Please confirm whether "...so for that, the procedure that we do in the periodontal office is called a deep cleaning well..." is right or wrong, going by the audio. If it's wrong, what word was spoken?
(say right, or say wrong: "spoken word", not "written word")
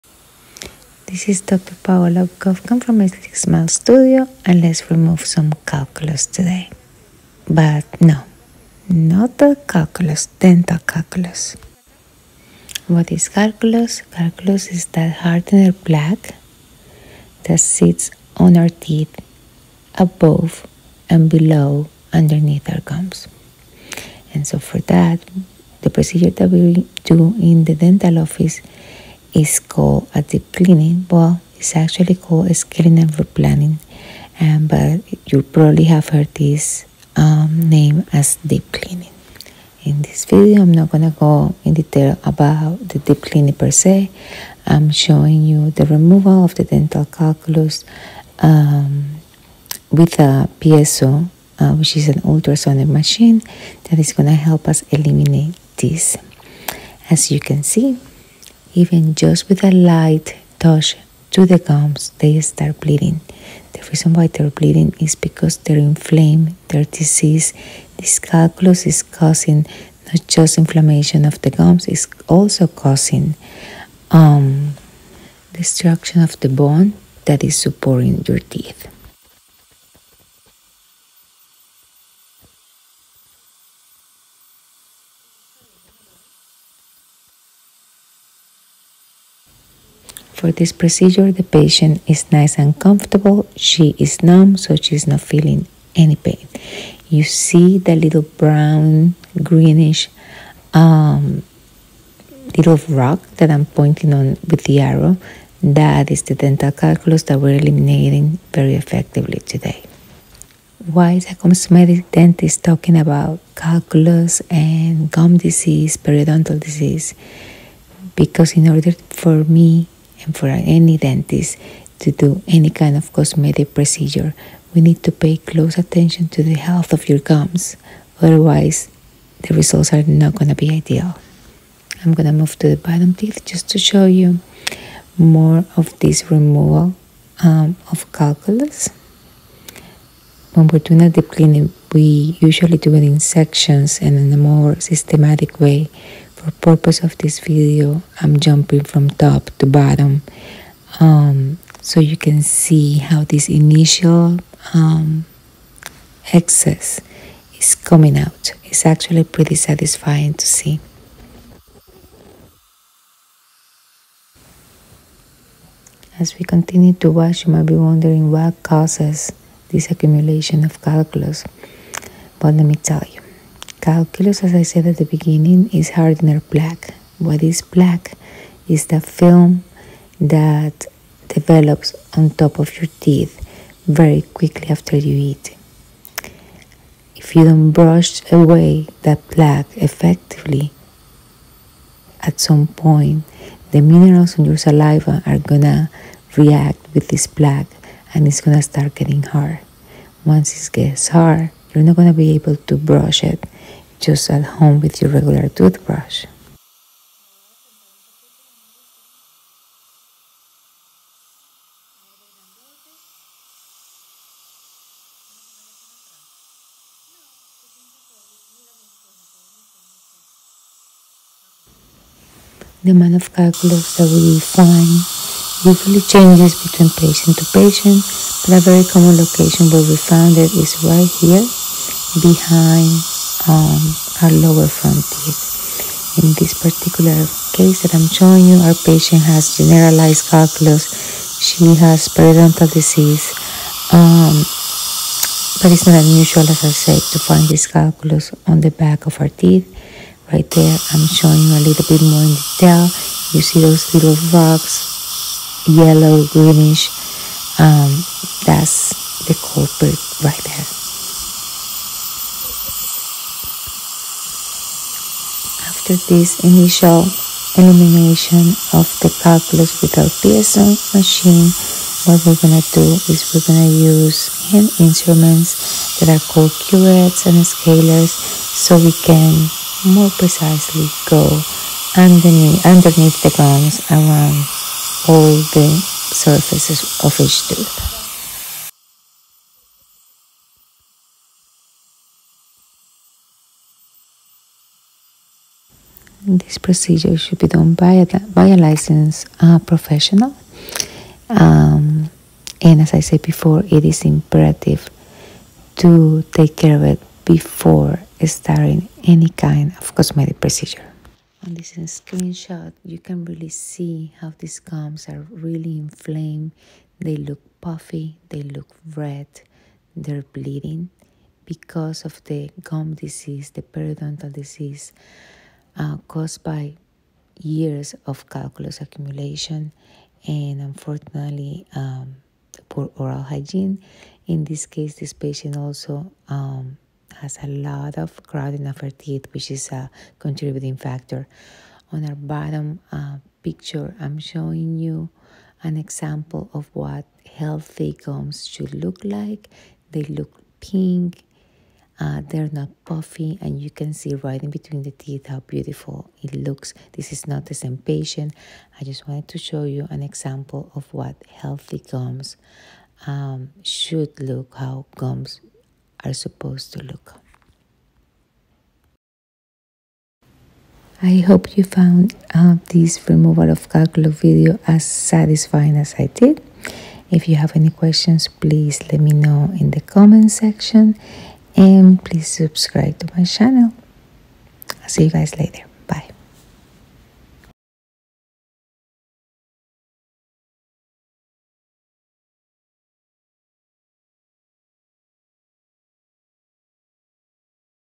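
wrong: "dental", not "periodontal".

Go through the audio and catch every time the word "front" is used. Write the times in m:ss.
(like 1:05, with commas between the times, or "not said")
3:54.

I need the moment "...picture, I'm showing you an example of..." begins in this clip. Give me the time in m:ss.
5:43.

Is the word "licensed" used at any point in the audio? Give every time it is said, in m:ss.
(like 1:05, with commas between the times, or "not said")
4:58.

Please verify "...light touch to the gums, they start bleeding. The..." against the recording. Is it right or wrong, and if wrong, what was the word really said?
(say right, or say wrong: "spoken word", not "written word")
right.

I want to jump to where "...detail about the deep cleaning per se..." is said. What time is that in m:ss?
0:41.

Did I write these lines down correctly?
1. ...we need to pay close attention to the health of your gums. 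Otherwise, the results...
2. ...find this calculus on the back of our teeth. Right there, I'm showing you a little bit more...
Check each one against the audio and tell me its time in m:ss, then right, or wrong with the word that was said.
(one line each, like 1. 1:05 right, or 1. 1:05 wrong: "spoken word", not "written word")
1. 2:04 right
2. 4:07 right.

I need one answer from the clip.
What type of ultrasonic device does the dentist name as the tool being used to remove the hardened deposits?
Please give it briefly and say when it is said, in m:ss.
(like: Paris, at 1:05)
piezo, at 0:50.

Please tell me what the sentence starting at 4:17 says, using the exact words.
Um, that's the culprit right there.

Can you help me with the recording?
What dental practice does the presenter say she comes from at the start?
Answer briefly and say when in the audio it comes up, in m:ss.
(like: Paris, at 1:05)
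Aesthetic Smile Studio, at 0:03.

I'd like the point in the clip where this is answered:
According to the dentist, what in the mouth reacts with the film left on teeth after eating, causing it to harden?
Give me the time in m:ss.
3:13.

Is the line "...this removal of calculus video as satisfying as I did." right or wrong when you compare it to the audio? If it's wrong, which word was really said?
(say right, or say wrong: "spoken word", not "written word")
right.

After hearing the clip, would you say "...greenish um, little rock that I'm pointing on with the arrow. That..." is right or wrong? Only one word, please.
right.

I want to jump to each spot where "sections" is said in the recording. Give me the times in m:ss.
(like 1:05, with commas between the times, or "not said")
2:23, 6:20.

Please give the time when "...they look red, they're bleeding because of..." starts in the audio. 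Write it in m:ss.
5:18.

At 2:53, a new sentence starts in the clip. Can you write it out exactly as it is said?
Calculus, as I said at the beginning, is hardener plaque.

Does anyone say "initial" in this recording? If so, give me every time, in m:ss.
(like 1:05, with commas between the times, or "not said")
2:33, 4:26.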